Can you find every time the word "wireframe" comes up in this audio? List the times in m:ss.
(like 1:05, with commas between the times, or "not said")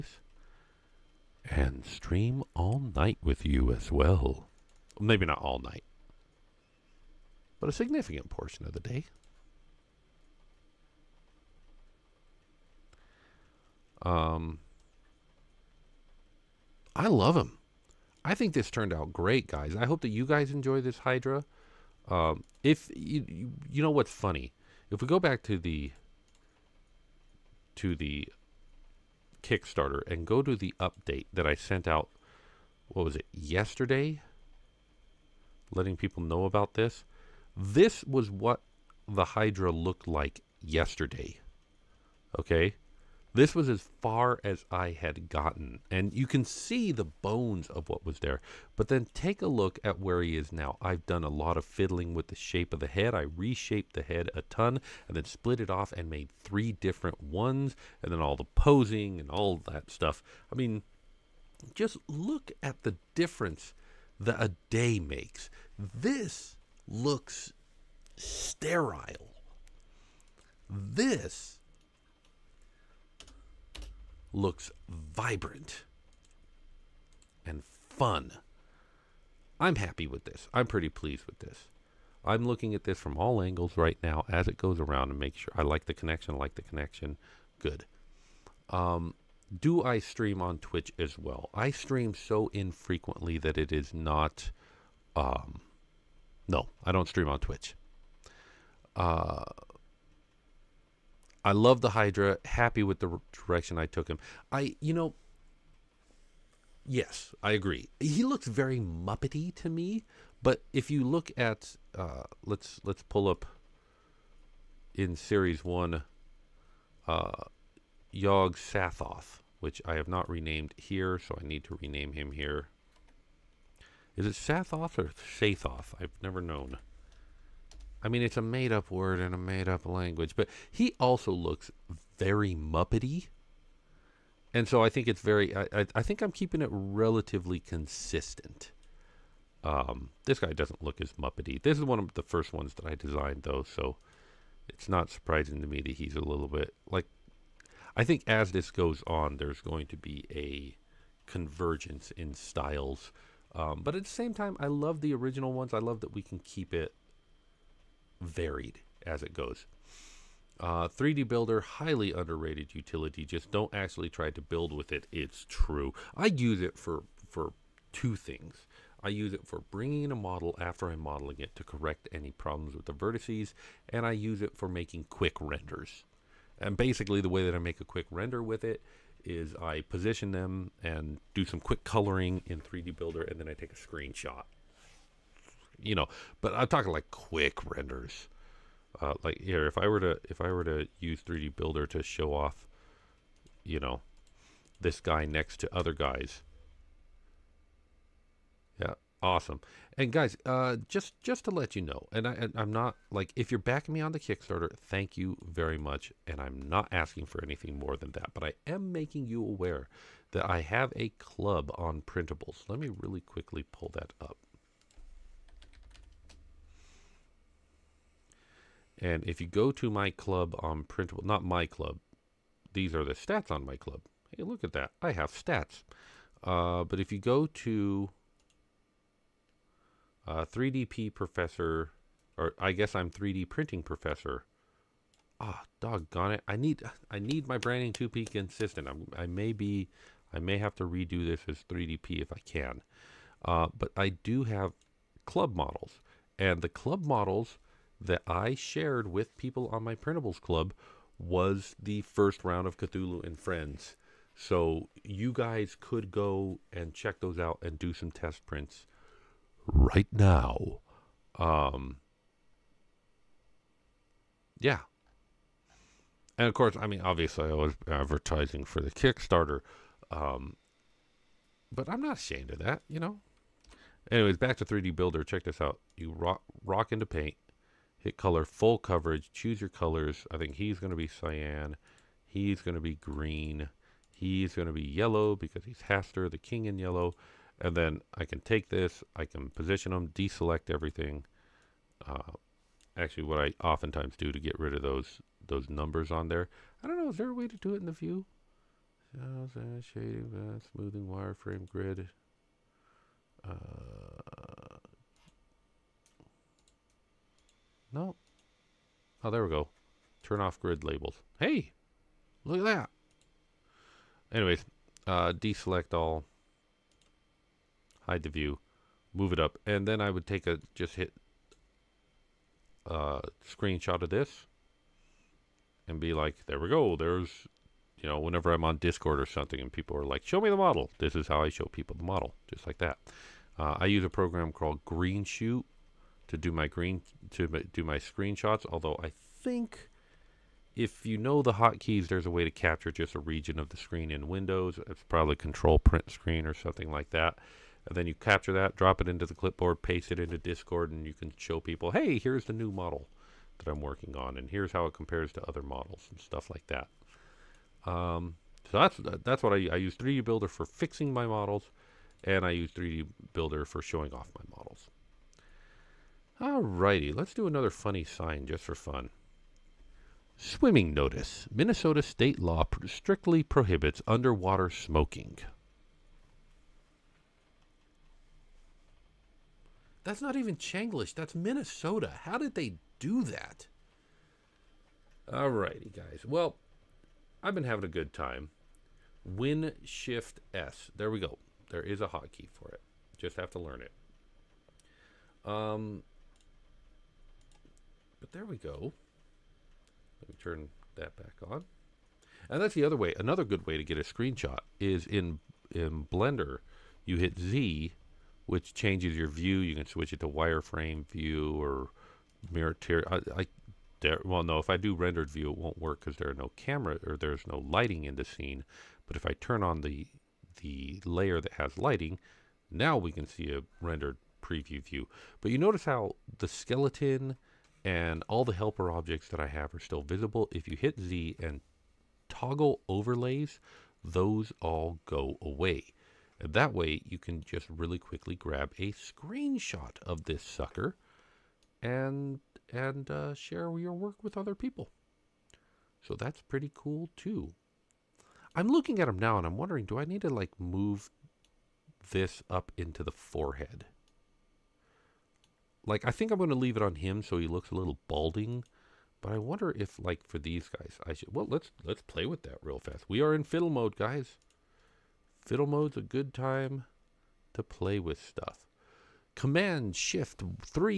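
5:01, 6:50.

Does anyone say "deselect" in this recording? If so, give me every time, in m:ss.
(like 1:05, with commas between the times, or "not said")
4:50, 5:15.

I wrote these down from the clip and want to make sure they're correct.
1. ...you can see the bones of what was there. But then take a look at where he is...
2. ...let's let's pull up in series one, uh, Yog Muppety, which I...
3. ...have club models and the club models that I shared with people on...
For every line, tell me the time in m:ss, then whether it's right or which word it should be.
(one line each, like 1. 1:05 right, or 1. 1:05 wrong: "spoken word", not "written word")
1. 0:46 right
2. 1:52 wrong: "Sathoth", not "Muppety"
3. 4:04 right.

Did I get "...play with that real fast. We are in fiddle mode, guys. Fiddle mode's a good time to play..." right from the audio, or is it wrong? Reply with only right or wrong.
right.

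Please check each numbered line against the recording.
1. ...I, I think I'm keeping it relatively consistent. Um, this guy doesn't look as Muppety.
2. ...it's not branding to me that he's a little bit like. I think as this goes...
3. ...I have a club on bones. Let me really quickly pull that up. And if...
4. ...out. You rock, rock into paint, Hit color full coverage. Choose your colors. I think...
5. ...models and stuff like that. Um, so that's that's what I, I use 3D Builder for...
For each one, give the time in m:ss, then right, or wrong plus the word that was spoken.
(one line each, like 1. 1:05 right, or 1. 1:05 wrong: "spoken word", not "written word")
1. 2:15 right
2. 2:24 wrong: "surprising", not "branding"
3. 3:30 wrong: "printables", not "bones"
4. 4:35 right
5. 5:55 right.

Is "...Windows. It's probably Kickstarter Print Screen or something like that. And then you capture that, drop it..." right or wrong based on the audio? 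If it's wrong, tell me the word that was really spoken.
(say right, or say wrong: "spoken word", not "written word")
wrong: "Control", not "Kickstarter".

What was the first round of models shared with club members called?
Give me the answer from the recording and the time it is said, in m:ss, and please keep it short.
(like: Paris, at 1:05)
Cthulhu and Friends, at 4:12.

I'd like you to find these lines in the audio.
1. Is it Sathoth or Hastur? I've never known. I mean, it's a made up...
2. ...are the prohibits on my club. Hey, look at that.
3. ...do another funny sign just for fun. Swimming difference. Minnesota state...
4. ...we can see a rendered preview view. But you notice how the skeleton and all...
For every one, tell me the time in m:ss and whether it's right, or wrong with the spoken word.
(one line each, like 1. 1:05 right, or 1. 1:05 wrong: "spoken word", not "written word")
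1. 2:04 wrong: "Sathoth", not "Hastur"
2. 3:42 wrong: "stats", not "prohibits"
3. 6:07 wrong: "notice", not "difference"
4. 7:02 right.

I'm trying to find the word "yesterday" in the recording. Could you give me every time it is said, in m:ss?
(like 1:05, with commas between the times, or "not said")
0:33, 0:40.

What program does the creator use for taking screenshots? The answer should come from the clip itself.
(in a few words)
Greenshot.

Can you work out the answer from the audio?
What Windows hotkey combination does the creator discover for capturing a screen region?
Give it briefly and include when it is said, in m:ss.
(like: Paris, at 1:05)
Win Shift S, at 6:29.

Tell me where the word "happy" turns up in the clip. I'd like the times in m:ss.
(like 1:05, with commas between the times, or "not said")
1:19, 1:42.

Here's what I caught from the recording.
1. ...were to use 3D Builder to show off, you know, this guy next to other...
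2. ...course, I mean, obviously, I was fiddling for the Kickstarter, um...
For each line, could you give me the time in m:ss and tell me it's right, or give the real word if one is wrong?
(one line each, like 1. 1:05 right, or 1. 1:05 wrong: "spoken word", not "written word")
1. 3:10 right
2. 4:26 wrong: "advertising", not "fiddling".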